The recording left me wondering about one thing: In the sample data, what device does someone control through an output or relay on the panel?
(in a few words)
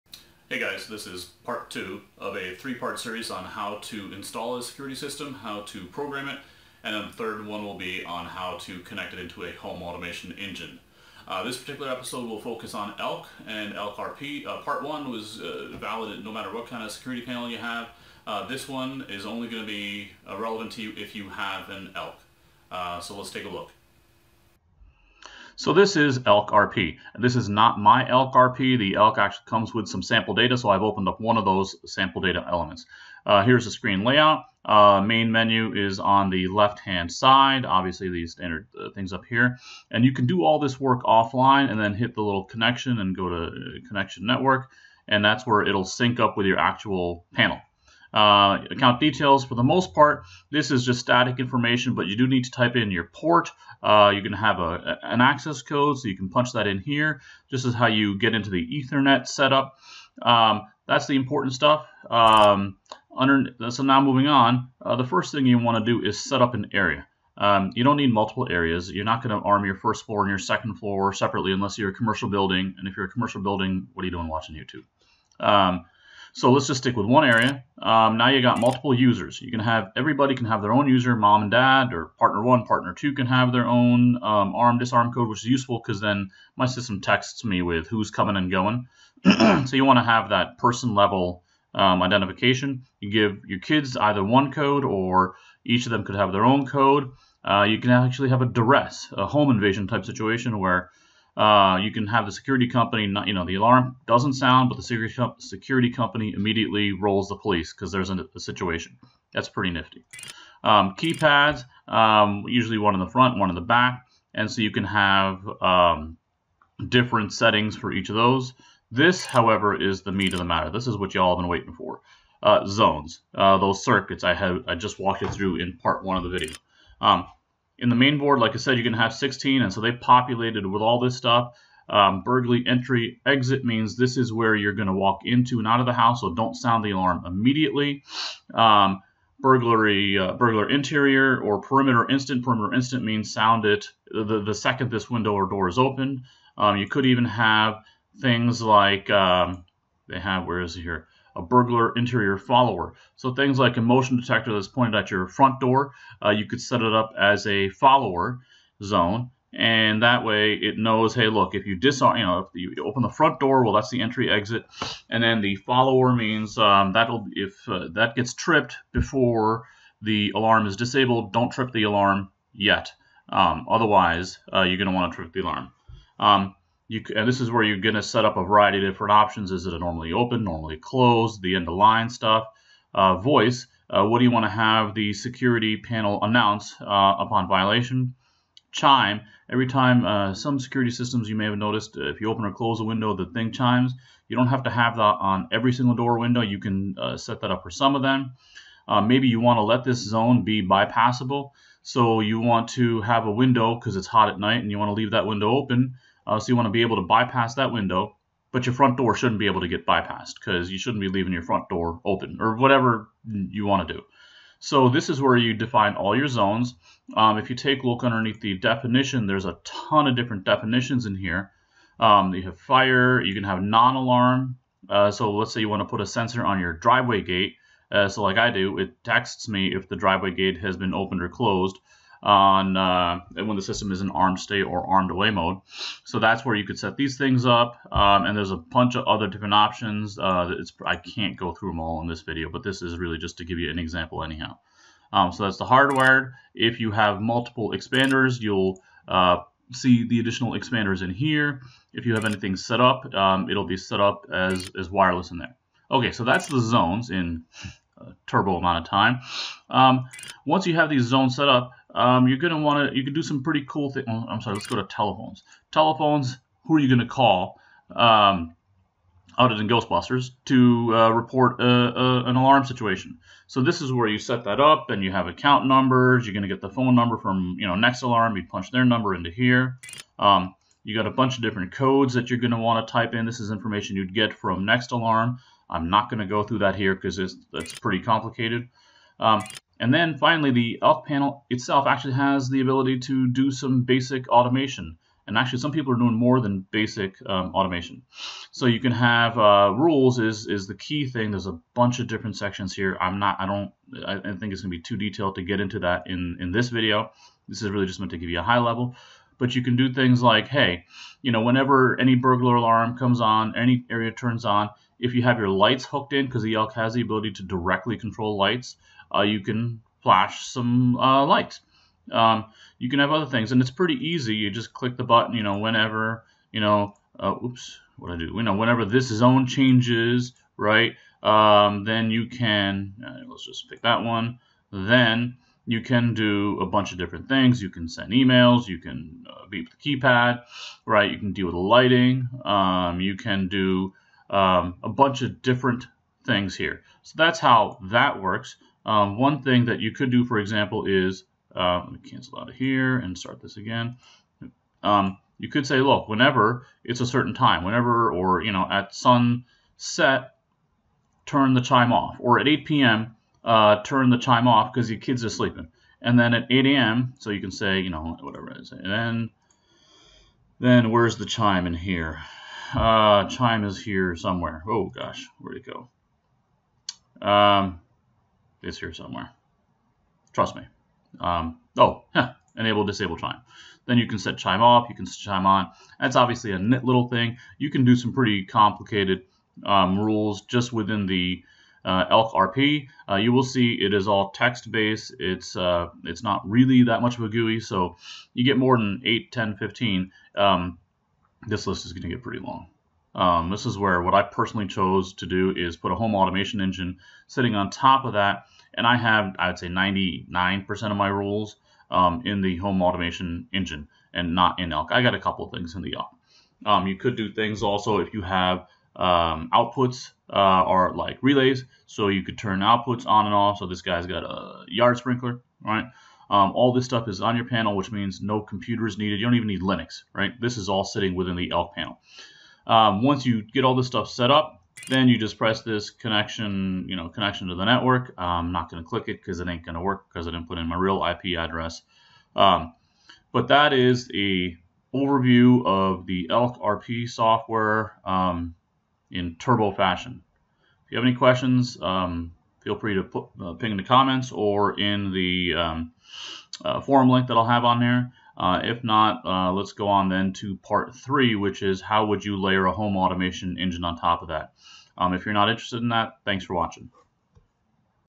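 yard sprinkler.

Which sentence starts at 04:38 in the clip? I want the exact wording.
You punch their number into here.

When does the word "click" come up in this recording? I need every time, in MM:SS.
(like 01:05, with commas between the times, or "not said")
05:24, 07:18.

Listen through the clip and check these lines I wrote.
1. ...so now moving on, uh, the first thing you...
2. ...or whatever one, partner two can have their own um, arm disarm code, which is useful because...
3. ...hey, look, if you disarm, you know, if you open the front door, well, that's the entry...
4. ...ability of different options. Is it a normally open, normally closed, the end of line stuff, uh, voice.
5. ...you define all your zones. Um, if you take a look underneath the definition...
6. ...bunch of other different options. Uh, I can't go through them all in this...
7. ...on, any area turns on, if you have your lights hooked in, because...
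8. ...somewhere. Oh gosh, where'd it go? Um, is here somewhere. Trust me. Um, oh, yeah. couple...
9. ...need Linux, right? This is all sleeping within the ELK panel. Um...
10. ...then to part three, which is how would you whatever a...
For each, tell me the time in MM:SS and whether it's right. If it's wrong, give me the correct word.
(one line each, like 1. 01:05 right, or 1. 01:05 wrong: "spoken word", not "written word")
1. 01:03 right
2. 01:21 wrong: "partner", not "whatever"
3. 02:41 right
4. 02:58 wrong: "variety", not "ability"
5. 03:35 right
6. 03:58 right
7. 05:13 right
8. 06:14 wrong: "enable", not "couple"
9. 07:09 wrong: "sitting", not "sleeping"
10. 07:40 wrong: "layer", not "whatever".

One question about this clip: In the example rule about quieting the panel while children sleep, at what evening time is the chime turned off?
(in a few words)
8 p.m.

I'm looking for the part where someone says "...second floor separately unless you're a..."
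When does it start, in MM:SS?
01:10.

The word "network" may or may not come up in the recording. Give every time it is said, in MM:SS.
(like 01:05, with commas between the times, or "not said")
00:44, 07:17.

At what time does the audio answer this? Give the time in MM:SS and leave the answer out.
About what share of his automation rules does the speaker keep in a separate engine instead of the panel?
06:49.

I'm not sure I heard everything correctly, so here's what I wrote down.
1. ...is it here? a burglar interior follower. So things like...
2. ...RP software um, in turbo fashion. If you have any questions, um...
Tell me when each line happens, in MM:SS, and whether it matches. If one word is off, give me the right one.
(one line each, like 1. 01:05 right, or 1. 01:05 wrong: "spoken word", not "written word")
1. 02:30 right
2. 07:26 right.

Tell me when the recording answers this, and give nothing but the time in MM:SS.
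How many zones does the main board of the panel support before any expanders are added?
02:09.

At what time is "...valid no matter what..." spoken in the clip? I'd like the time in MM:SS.
00:15.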